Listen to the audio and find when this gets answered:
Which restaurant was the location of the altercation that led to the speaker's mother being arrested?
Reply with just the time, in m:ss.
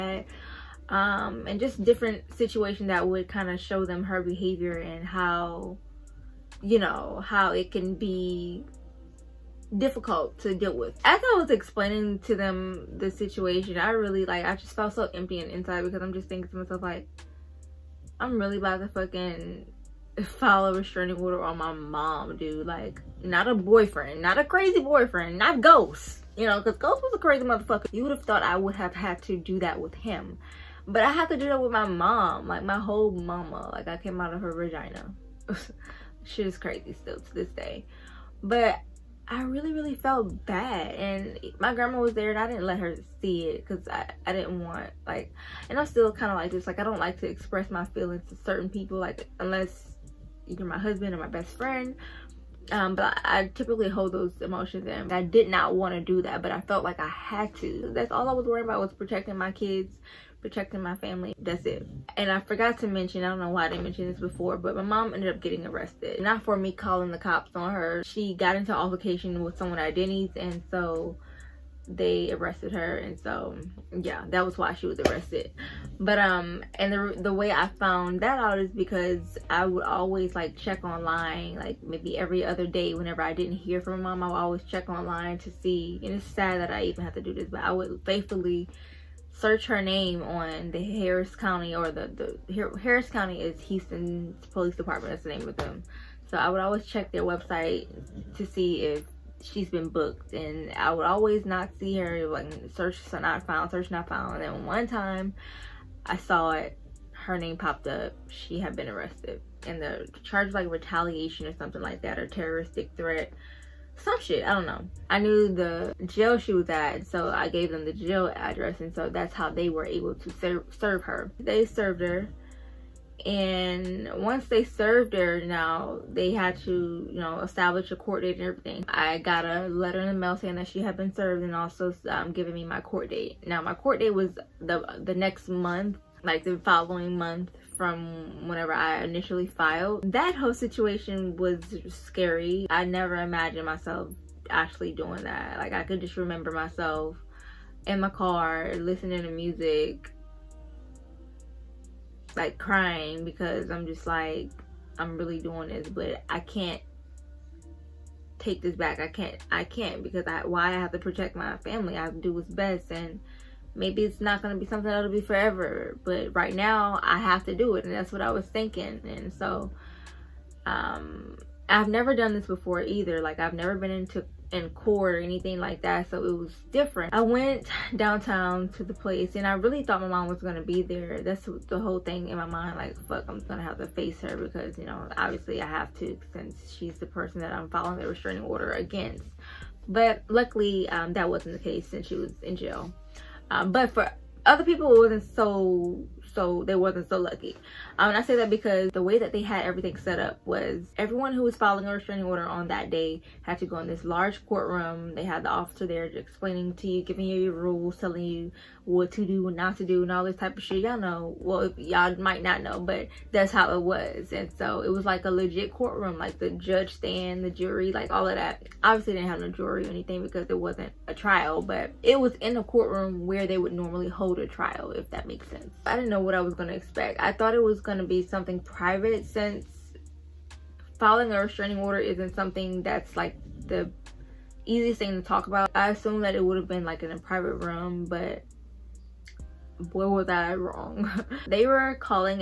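1:09.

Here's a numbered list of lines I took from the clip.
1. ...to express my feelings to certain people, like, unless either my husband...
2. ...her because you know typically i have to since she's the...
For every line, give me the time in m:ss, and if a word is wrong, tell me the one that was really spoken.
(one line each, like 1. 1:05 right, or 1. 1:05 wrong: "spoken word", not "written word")
1. 0:47 right
2. 3:04 wrong: "obviously", not "typically".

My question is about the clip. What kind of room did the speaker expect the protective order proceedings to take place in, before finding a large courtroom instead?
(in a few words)
a private room.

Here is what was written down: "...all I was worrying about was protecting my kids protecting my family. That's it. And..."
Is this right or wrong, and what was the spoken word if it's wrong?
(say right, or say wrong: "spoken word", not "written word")
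right.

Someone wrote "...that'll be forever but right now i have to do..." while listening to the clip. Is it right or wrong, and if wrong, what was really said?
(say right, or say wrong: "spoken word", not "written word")
right.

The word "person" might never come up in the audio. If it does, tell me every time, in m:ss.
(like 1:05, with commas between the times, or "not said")
3:07.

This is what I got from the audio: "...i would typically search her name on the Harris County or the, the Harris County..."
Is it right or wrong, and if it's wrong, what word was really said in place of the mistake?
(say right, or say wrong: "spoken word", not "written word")
wrong: "faithfully", not "typically".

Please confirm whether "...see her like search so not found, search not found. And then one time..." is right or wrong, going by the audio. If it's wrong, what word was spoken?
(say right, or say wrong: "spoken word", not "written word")
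right.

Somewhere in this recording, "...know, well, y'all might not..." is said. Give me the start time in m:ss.
3:30.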